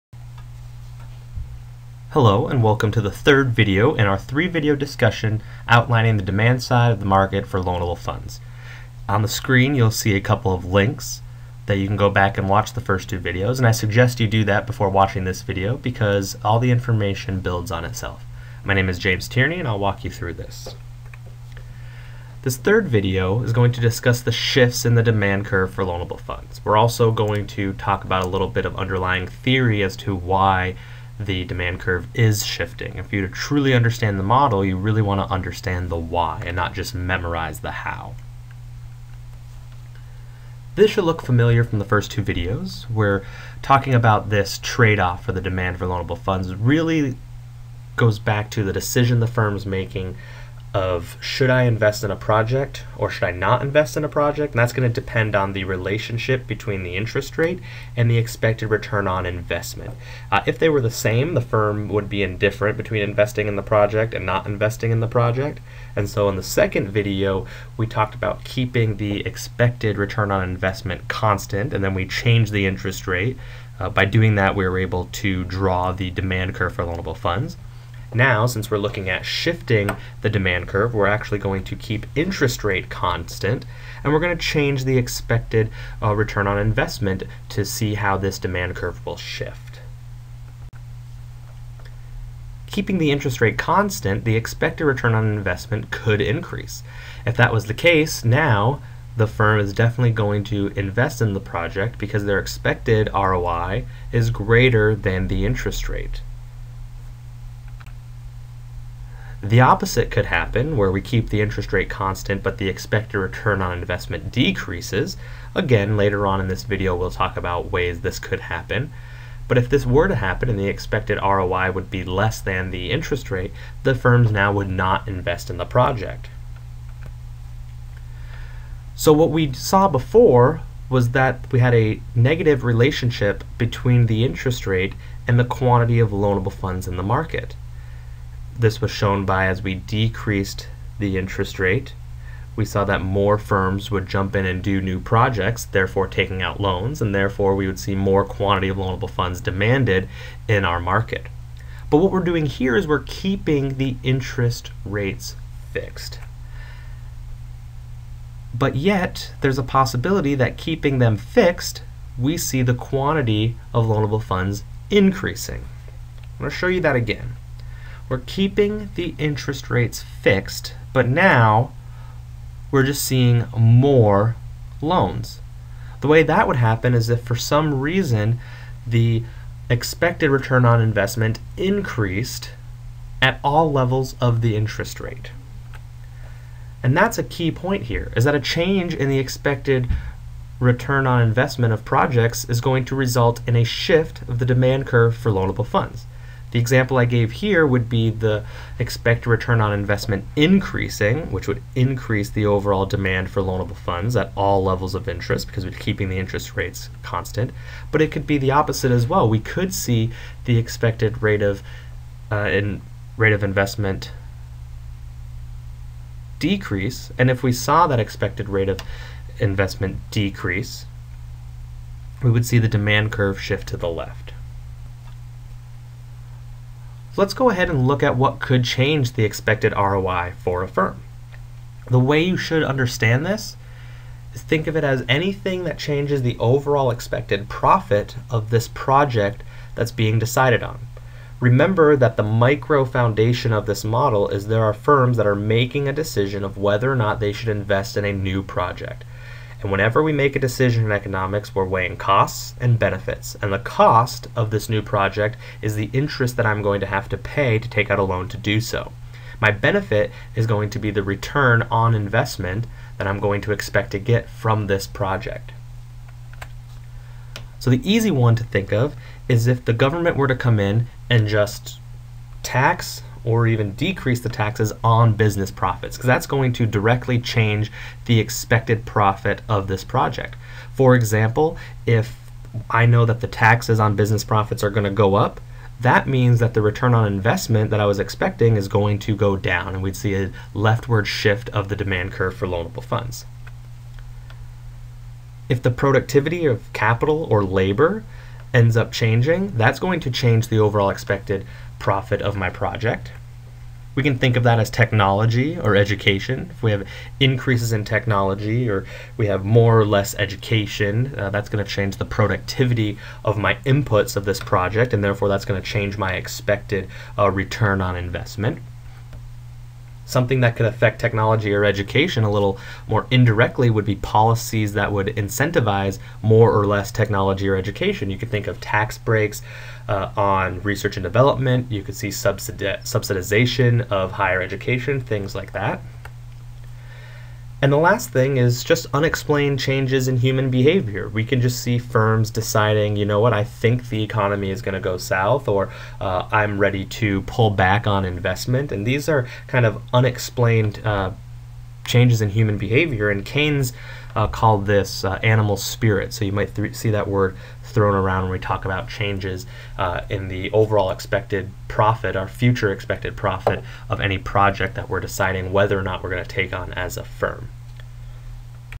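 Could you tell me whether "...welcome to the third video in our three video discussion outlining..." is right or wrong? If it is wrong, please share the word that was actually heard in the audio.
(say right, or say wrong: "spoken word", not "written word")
right.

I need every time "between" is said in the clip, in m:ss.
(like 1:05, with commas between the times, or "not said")
0:56, 1:02, 2:13.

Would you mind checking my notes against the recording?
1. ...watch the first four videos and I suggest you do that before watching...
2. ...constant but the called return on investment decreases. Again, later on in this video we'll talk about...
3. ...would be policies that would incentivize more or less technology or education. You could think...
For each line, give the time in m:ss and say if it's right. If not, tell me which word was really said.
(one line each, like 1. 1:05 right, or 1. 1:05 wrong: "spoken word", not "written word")
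1. 0:12 wrong: "two", not "four"
2. 1:51 wrong: "expected", not "called"
3. 5:23 right.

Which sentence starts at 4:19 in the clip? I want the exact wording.
My benefit is going to be the return on investment that I'm going to expect to get from this project.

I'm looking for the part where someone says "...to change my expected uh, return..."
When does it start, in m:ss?
5:15.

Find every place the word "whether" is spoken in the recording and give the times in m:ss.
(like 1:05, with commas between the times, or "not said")
4:06, 6:05.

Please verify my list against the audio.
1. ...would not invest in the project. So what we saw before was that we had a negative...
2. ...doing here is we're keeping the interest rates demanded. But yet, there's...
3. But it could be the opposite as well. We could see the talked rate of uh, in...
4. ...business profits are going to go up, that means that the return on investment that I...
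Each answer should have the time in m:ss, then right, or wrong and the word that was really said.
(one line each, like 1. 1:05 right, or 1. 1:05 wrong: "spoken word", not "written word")
1. 2:04 right
2. 2:32 wrong: "fixed", not "demanded"
3. 3:27 wrong: "expected", not "talked"
4. 4:43 right.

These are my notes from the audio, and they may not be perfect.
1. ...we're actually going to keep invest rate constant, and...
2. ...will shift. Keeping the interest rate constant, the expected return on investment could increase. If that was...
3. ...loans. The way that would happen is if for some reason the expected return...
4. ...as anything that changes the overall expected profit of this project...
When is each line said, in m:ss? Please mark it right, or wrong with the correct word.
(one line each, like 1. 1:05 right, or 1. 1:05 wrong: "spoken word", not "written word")
1. 1:20 wrong: "interest", not "invest"
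2. 1:29 right
3. 2:54 right
4. 3:54 right.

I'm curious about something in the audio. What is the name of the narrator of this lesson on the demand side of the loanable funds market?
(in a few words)
James Tierney.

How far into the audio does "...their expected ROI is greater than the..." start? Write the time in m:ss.
1:42.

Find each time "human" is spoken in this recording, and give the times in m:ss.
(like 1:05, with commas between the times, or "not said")
5:40, 5:52.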